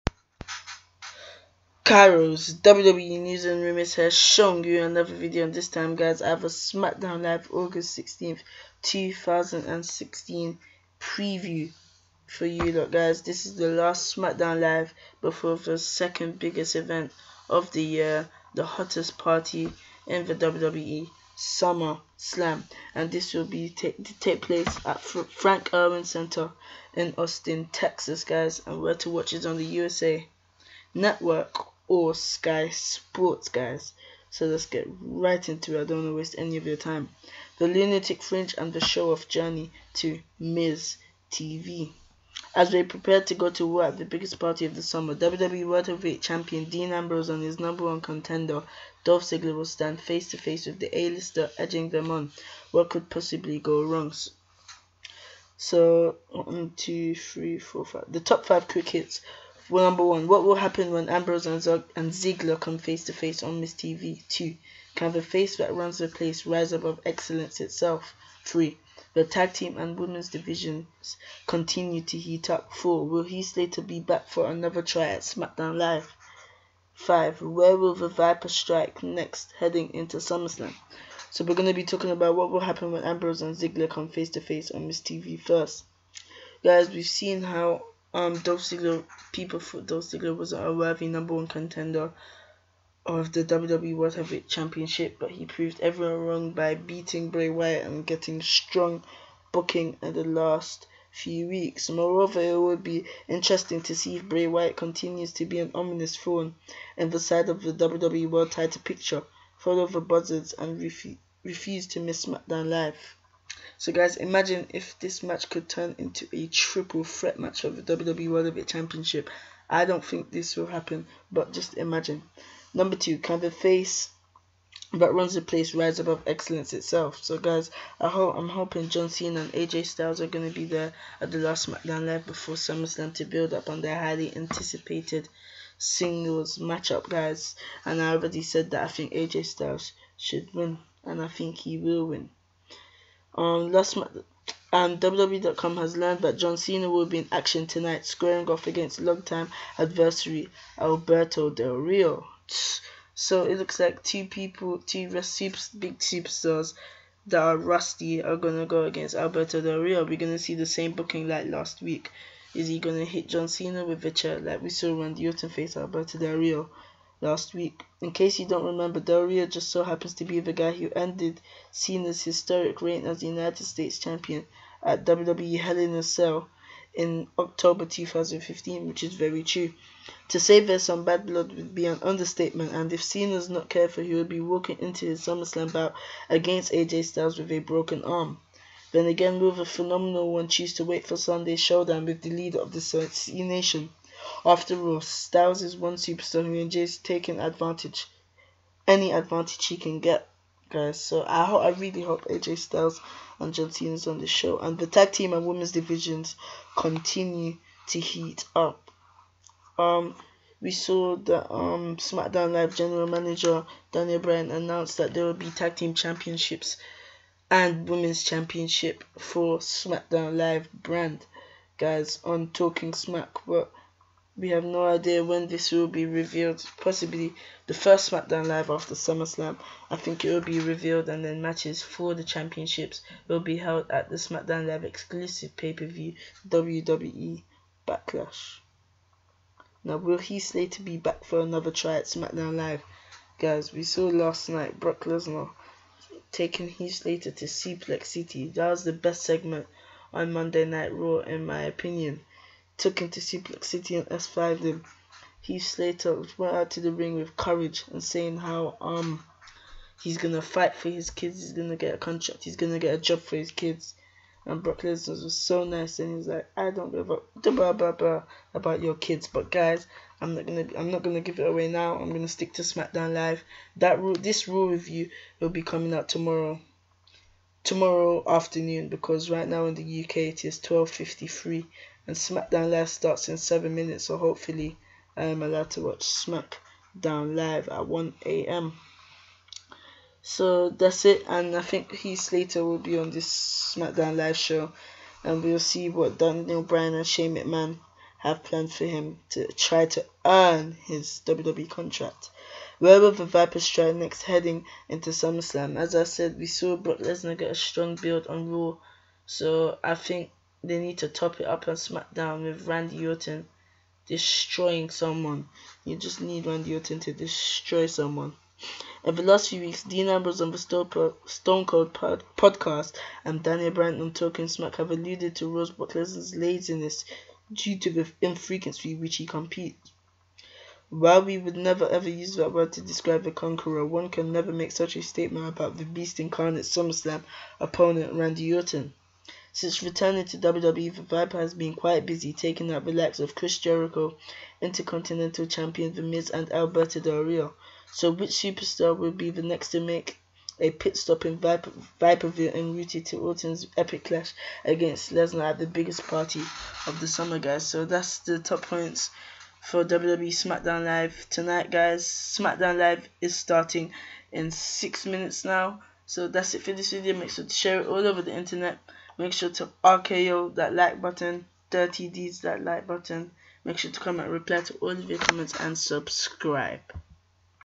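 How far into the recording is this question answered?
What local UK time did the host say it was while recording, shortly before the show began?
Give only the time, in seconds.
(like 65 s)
280 s.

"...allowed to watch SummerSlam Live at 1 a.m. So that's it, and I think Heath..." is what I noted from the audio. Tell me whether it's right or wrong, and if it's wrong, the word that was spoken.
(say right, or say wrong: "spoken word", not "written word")
wrong: "SmackDown", not "SummerSlam".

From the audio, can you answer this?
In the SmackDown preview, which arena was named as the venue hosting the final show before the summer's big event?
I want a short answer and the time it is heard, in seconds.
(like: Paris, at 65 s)
Frank Erwin Center, at 25 s.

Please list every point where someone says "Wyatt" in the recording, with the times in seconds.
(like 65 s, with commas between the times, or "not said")
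97 s, 104 s.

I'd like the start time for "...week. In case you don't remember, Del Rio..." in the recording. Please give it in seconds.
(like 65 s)
167 s.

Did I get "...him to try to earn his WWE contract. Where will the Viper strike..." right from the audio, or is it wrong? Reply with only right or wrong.
right.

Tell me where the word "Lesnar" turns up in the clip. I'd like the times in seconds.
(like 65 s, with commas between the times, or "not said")
245 s, 264 s, 306 s, 325 s, 355 s.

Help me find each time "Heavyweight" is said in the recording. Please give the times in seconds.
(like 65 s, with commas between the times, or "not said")
45 s, 94 s, 118 s.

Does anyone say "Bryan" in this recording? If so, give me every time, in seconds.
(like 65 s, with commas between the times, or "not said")
214 s, 296 s, 323 s.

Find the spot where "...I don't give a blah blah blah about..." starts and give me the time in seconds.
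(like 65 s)
266 s.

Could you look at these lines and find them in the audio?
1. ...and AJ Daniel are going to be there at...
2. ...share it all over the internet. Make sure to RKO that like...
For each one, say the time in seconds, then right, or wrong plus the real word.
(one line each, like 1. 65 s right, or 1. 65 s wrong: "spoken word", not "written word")
1. 129 s wrong: "Styles", not "Daniel"
2. 367 s right.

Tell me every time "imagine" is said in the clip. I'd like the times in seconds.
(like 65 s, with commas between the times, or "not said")
114 s, 121 s.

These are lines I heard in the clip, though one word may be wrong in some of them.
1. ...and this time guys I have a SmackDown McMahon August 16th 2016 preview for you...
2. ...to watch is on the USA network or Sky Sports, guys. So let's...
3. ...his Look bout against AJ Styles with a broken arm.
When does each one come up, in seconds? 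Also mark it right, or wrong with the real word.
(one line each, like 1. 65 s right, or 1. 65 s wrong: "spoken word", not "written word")
1. 5 s wrong: "Live", not "McMahon"
2. 28 s right
3. 185 s wrong: "SummerSlam", not "Look".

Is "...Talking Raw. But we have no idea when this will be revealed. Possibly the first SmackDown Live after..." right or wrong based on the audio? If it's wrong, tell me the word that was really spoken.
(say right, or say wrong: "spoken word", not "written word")
wrong: "Smack", not "Raw".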